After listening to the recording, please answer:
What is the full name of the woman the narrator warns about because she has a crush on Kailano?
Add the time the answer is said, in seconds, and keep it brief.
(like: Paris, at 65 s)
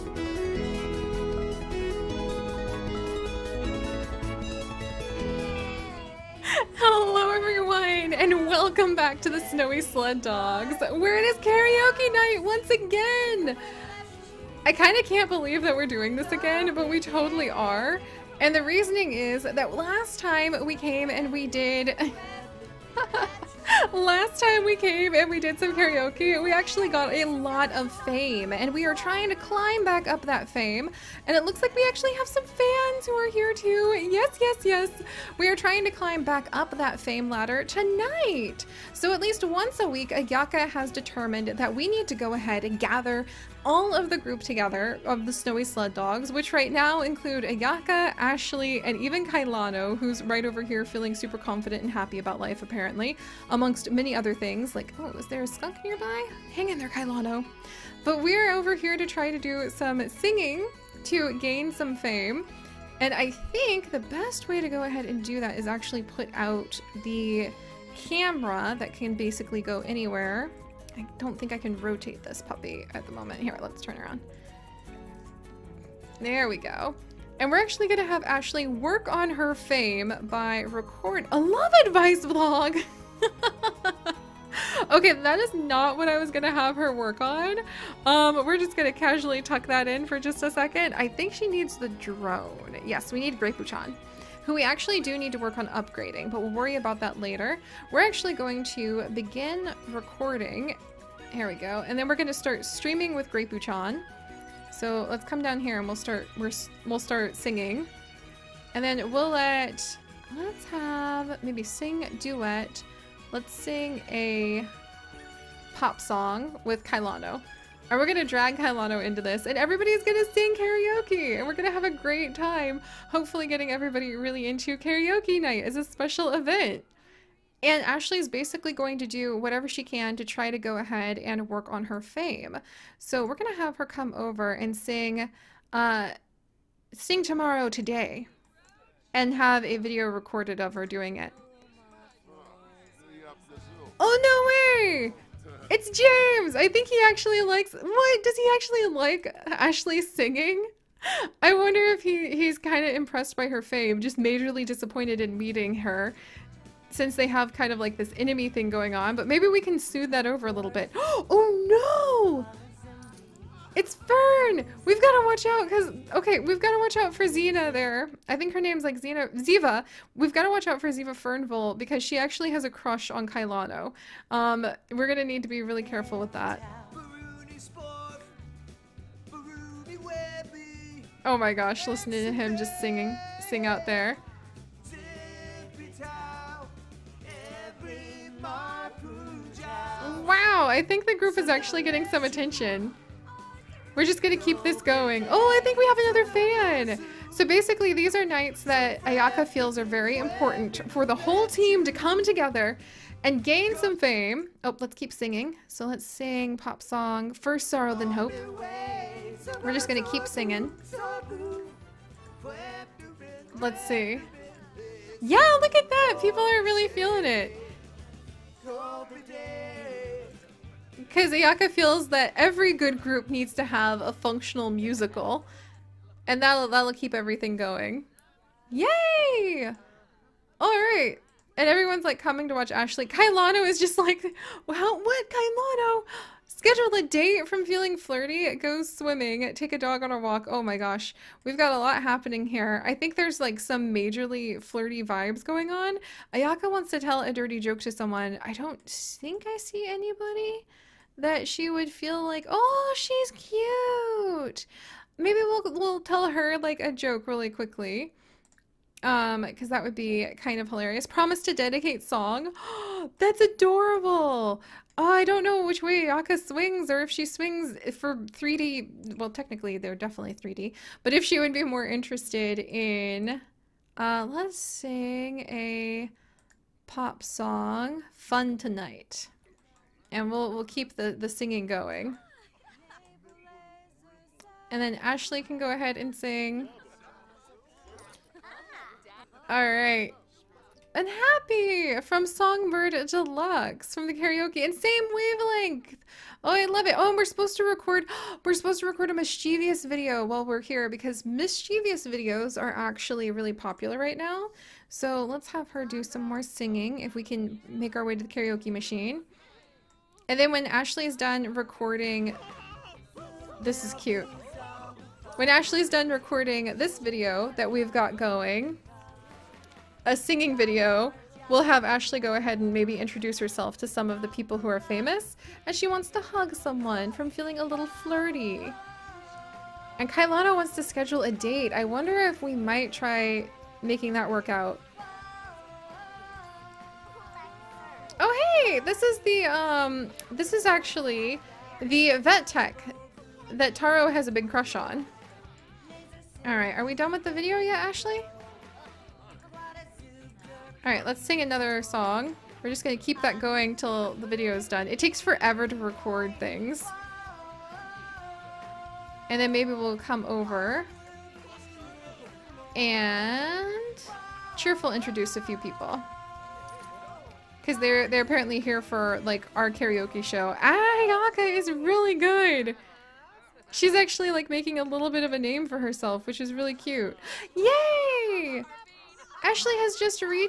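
Ziva Fernville, at 170 s.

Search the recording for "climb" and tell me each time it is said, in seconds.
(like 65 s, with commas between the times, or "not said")
29 s, 35 s.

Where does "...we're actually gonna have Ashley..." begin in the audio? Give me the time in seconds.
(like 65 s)
77 s.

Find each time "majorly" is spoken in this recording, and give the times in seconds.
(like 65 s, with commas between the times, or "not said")
154 s, 243 s.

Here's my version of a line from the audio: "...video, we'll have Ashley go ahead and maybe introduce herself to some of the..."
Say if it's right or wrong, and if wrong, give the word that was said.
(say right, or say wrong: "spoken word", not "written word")
right.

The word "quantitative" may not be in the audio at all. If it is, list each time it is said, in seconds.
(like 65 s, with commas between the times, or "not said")
not said.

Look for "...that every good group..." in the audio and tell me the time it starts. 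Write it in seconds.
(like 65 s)
222 s.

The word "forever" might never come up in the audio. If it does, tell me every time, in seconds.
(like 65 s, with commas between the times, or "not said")
355 s.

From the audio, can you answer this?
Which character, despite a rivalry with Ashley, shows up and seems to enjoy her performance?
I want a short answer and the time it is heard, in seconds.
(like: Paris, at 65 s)
James, at 145 s.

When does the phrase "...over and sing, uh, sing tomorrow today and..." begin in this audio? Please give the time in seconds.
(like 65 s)
134 s.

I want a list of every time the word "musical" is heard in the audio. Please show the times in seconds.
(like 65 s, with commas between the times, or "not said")
224 s.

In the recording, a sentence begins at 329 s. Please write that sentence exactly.
And Kailano wants to schedule a date.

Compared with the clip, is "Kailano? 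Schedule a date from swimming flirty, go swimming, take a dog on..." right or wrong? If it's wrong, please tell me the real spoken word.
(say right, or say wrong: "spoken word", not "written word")
wrong: "feeling", not "swimming".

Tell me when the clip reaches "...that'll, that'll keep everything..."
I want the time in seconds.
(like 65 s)
226 s.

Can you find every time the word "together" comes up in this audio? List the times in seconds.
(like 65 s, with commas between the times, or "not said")
44 s, 202 s.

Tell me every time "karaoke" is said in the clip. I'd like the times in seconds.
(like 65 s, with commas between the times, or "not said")
11 s, 25 s, 120 s, 124 s, 294 s, 308 s, 369 s.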